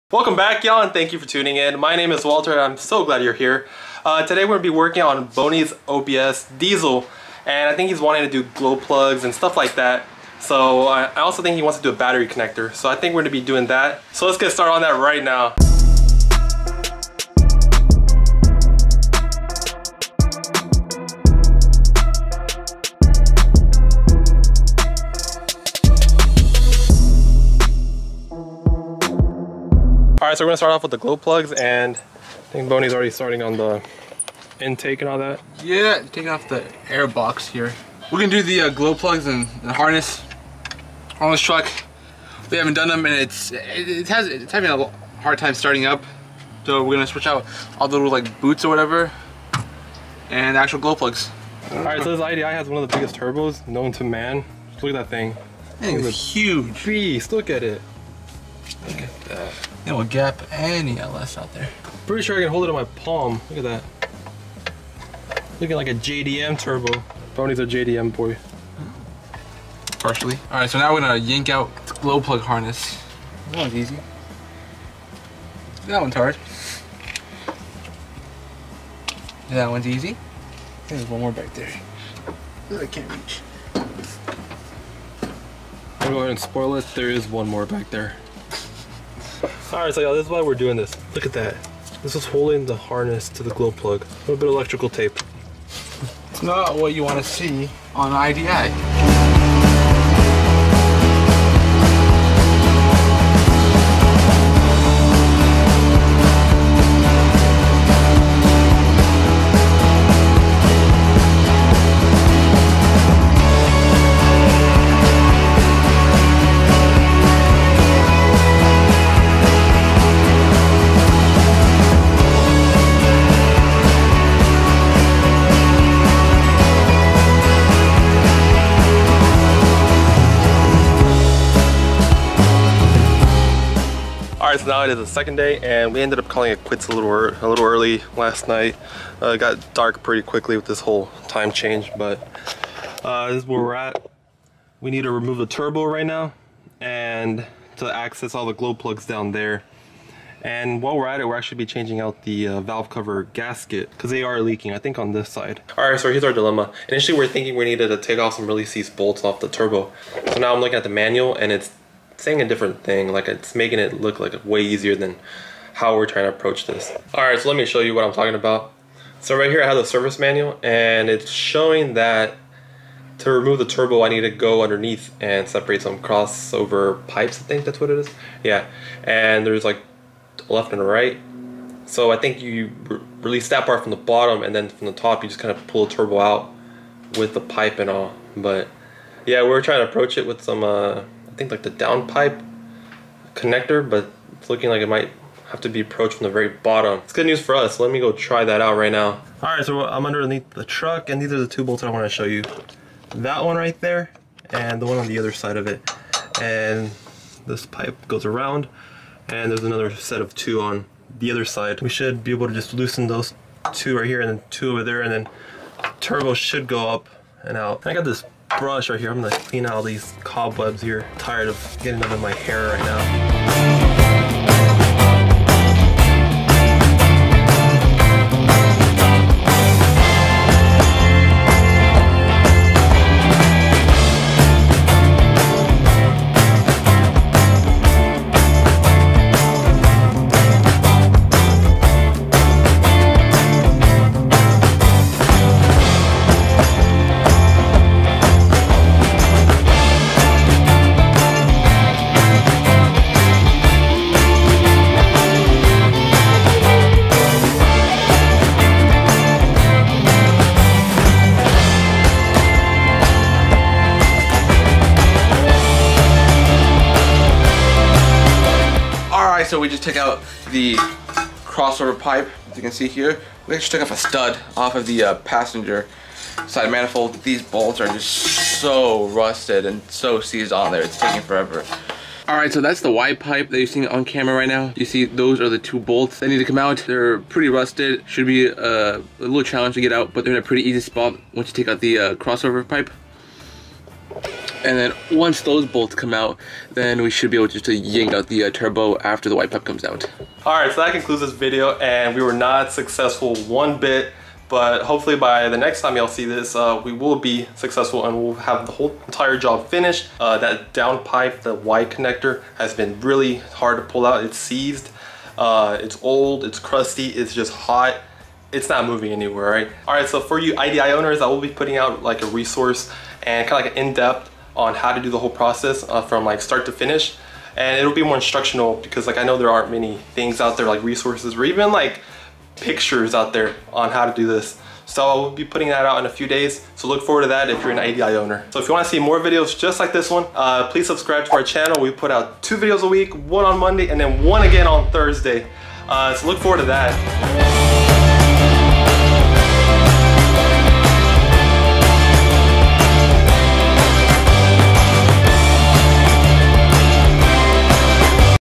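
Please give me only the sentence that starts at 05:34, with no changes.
So I will be putting that out in a few days.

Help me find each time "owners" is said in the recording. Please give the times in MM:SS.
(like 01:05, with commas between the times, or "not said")
05:20, 05:38.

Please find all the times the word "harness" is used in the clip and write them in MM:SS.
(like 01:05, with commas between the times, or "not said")
00:39, 01:12, 01:32.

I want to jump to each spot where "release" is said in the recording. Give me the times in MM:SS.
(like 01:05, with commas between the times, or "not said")
02:38, 03:03.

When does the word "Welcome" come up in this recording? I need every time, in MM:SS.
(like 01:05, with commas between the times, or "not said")
00:00.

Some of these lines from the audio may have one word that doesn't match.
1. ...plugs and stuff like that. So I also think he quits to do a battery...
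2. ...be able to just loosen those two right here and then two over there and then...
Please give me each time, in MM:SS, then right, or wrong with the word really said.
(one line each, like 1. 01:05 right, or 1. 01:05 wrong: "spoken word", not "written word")
1. 00:08 wrong: "wants", not "quits"
2. 03:32 right.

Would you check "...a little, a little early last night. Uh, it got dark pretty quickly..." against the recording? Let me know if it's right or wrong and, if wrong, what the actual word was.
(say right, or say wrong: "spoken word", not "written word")
right.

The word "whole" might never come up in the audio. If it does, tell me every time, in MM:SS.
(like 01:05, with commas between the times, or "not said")
02:20, 05:08, 05:25.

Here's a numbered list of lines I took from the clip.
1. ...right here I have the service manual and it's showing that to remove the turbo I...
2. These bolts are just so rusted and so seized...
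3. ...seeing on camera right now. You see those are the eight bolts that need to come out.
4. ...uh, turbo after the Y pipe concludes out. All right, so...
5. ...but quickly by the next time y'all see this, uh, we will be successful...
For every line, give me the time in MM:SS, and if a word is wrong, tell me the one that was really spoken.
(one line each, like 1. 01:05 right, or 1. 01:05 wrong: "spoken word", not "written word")
1. 02:49 right
2. 04:37 right
3. 04:43 wrong: "two", not "eight"
4. 04:58 wrong: "comes", not "concludes"
5. 05:04 wrong: "hopefully", not "quickly".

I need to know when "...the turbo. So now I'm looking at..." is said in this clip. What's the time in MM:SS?
02:39.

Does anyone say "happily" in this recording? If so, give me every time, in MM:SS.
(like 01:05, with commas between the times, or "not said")
not said.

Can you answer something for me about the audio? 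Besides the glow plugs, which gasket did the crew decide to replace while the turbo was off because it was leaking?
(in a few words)
valve cover gasket.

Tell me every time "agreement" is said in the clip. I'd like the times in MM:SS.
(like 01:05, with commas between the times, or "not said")
not said.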